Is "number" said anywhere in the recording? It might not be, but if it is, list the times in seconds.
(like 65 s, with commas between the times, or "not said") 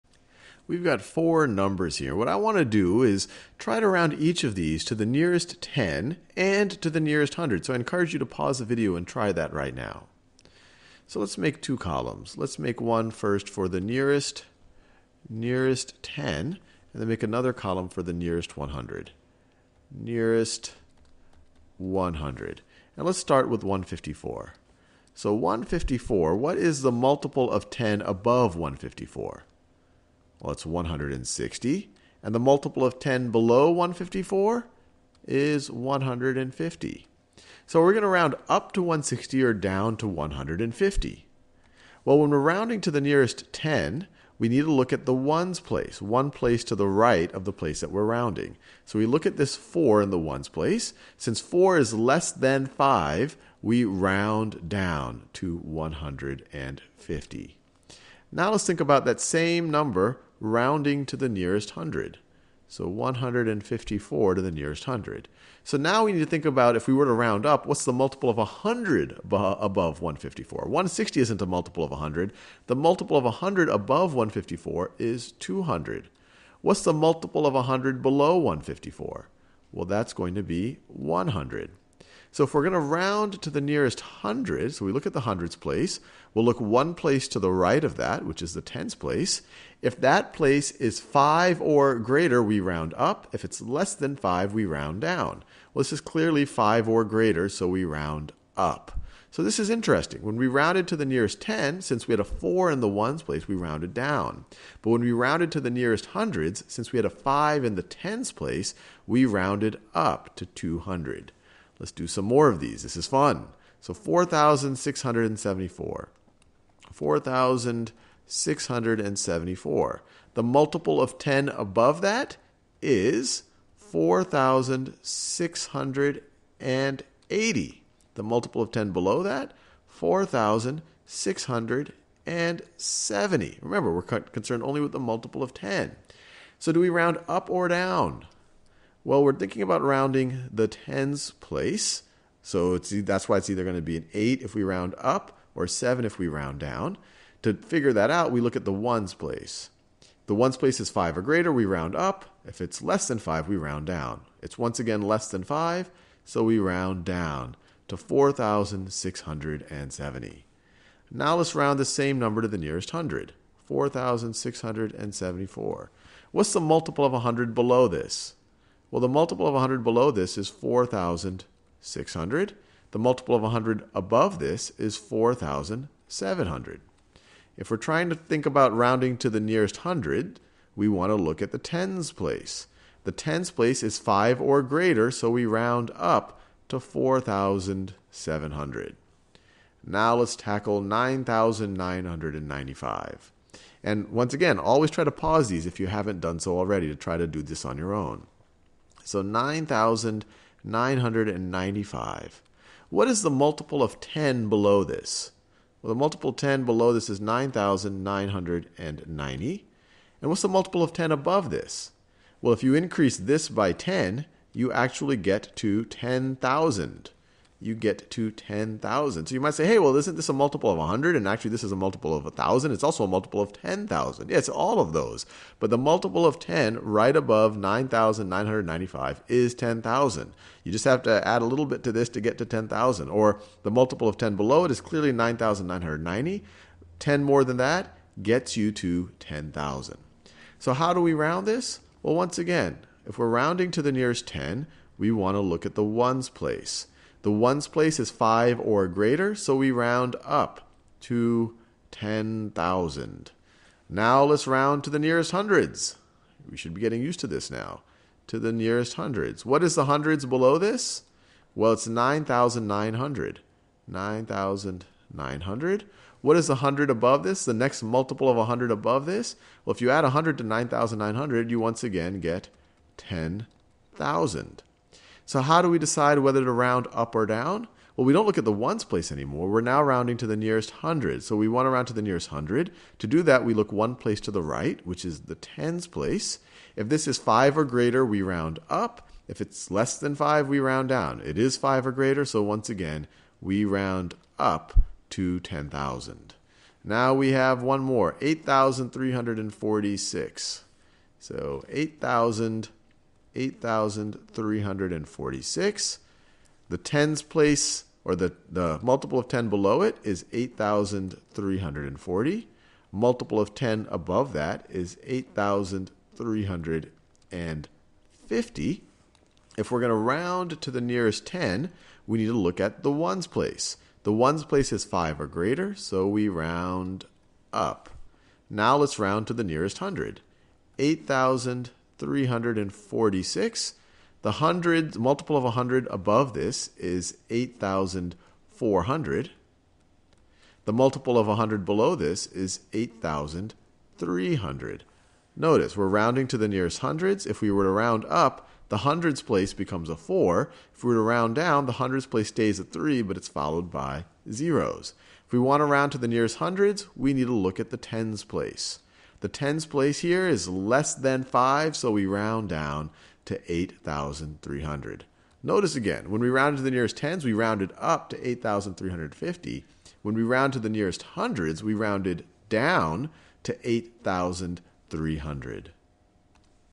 1 s, 59 s, 162 s.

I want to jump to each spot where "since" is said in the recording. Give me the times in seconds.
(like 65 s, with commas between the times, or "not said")
51 s, 101 s, 106 s.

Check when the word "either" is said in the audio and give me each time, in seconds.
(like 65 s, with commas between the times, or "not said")
143 s.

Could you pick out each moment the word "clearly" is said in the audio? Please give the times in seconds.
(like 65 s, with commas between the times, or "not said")
95 s, 234 s.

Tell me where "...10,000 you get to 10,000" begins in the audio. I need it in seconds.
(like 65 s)
215 s.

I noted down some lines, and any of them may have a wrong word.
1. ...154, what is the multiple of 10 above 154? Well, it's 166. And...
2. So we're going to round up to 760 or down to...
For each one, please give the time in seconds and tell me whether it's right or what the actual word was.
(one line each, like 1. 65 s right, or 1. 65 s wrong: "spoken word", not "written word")
1. 25 s wrong: "160", not "166"
2. 37 s wrong: "160", not "760".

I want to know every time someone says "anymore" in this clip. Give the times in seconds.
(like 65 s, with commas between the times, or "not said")
279 s.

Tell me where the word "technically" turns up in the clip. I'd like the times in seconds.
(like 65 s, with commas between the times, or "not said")
not said.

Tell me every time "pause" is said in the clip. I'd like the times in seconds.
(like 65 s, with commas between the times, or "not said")
8 s, 195 s.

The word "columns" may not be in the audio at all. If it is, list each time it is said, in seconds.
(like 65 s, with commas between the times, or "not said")
11 s, 17 s.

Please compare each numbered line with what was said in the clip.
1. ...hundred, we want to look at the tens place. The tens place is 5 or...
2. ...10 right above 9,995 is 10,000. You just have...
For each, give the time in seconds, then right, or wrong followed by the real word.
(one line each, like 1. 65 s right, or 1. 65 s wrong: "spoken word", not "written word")
1. 179 s right
2. 226 s right.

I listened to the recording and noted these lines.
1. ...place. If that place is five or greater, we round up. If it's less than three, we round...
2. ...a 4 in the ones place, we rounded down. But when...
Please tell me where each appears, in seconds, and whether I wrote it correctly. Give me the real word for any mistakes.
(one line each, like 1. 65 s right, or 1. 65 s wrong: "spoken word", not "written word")
1. 88 s wrong: "five", not "three"
2. 102 s right.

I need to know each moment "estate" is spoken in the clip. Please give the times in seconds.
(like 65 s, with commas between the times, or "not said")
not said.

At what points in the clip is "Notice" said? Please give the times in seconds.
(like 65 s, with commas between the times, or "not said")
345 s, 365 s.